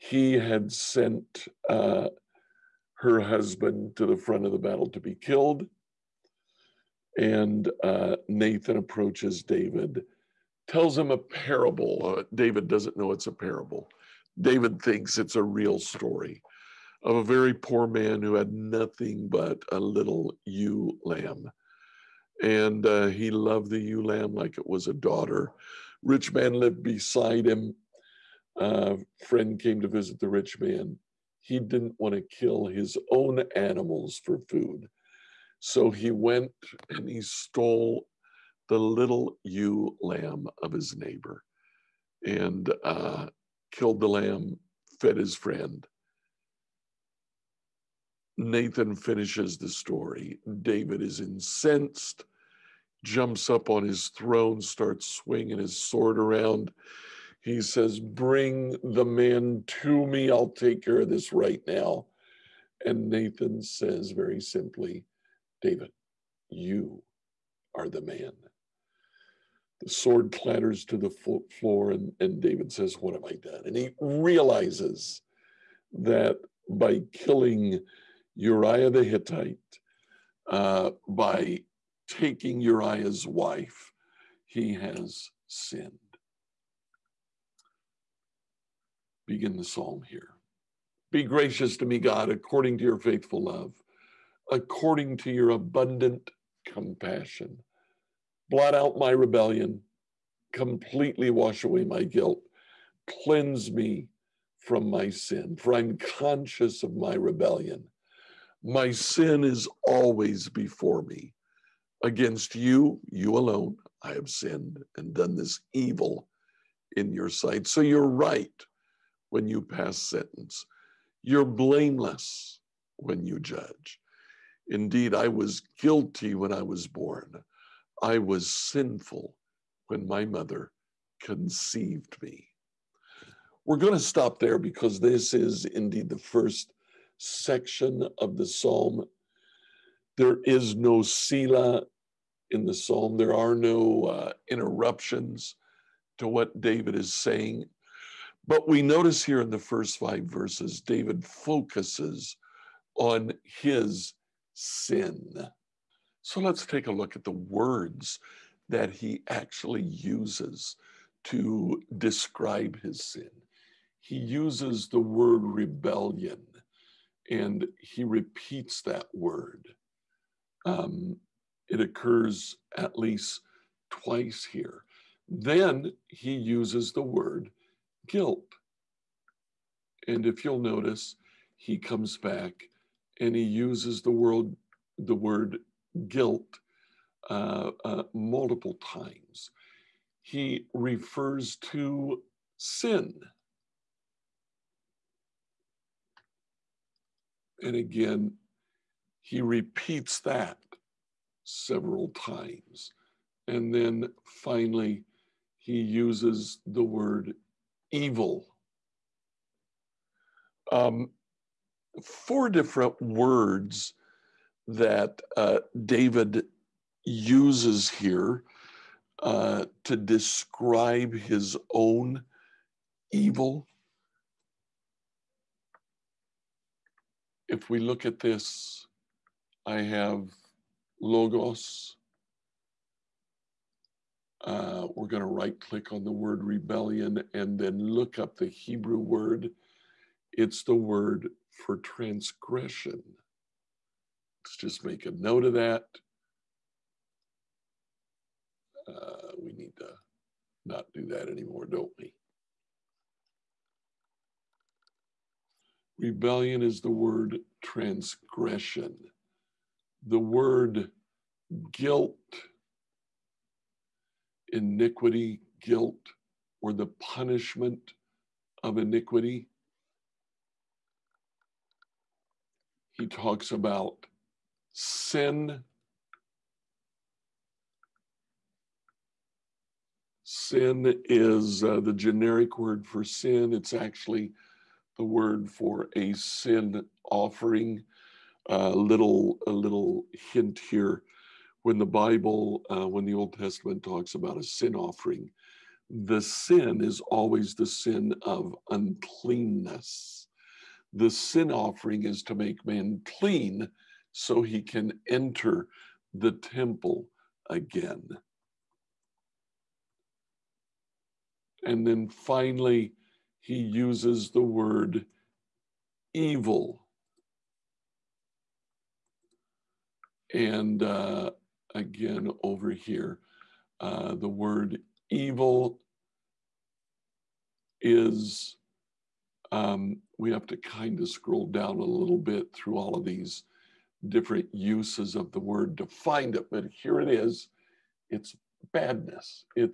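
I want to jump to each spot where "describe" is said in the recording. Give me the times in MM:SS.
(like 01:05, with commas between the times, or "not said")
02:41, 03:39.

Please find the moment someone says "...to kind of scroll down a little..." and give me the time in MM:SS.
05:30.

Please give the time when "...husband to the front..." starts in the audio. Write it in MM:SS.
00:03.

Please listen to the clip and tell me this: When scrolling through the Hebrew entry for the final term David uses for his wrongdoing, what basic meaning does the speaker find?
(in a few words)
badness.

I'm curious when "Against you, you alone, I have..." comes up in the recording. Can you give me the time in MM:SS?
01:52.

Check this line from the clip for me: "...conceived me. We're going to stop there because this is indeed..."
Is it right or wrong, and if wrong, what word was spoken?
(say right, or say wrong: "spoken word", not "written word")
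right.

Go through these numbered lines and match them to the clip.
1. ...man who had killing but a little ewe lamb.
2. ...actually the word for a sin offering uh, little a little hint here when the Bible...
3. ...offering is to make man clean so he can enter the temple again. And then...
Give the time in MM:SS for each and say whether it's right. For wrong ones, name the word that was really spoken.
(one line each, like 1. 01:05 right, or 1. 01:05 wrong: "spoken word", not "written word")
1. 00:17 wrong: "nothing", not "killing"
2. 04:43 right
3. 05:01 right.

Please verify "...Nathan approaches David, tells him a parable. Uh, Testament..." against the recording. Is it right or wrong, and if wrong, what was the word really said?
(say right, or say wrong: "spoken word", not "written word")
wrong: "David", not "Testament".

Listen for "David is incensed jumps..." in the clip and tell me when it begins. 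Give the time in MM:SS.
00:50.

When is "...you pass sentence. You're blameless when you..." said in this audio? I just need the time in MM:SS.
01:59.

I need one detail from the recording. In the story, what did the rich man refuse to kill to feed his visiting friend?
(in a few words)
his own animals.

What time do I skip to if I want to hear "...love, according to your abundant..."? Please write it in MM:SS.
01:33.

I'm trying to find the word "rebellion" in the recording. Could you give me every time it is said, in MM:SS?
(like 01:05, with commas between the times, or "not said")
01:39, 01:47, 02:45, 03:56, 04:15.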